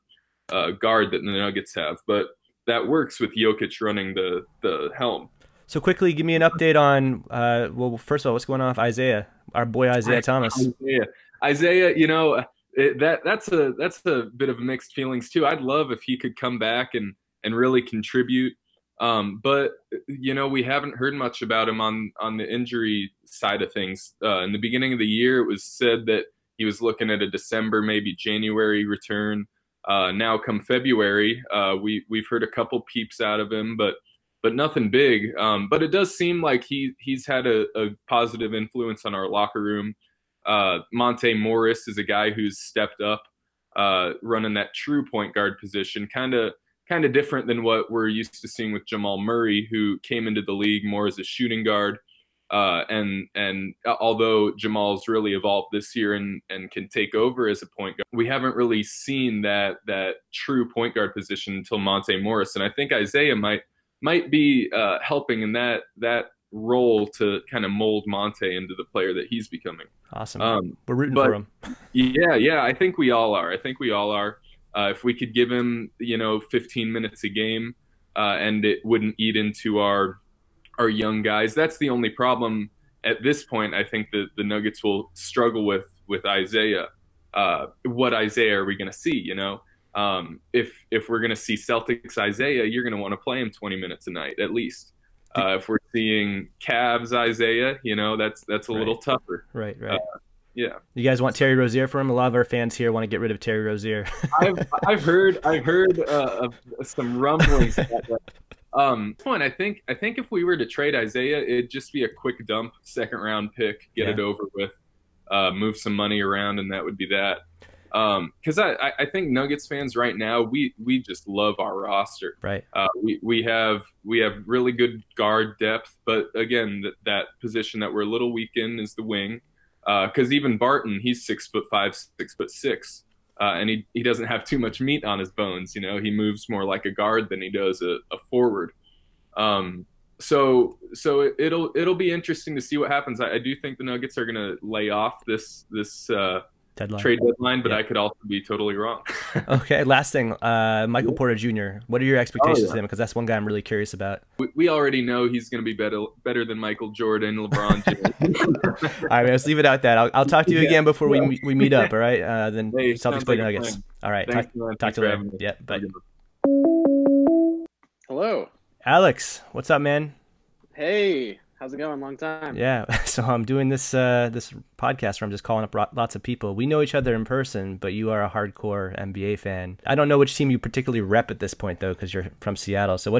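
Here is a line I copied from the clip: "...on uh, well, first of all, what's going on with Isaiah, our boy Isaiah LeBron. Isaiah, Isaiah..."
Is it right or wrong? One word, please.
wrong.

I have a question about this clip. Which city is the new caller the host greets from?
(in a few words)
Seattle.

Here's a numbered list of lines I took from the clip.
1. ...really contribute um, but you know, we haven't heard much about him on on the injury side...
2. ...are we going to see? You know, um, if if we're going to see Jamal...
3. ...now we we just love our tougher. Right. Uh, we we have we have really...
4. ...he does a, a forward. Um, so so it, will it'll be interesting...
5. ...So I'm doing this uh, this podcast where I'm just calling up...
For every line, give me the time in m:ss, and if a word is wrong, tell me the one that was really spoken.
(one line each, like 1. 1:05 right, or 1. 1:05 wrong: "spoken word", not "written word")
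1. 0:17 right
2. 1:28 wrong: "Celtics", not "Jamal"
3. 2:00 wrong: "roster", not "tougher"
4. 2:17 right
5. 2:53 right.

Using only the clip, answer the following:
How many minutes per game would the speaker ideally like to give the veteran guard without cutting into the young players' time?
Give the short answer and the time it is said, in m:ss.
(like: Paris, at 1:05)
15, at 1:16.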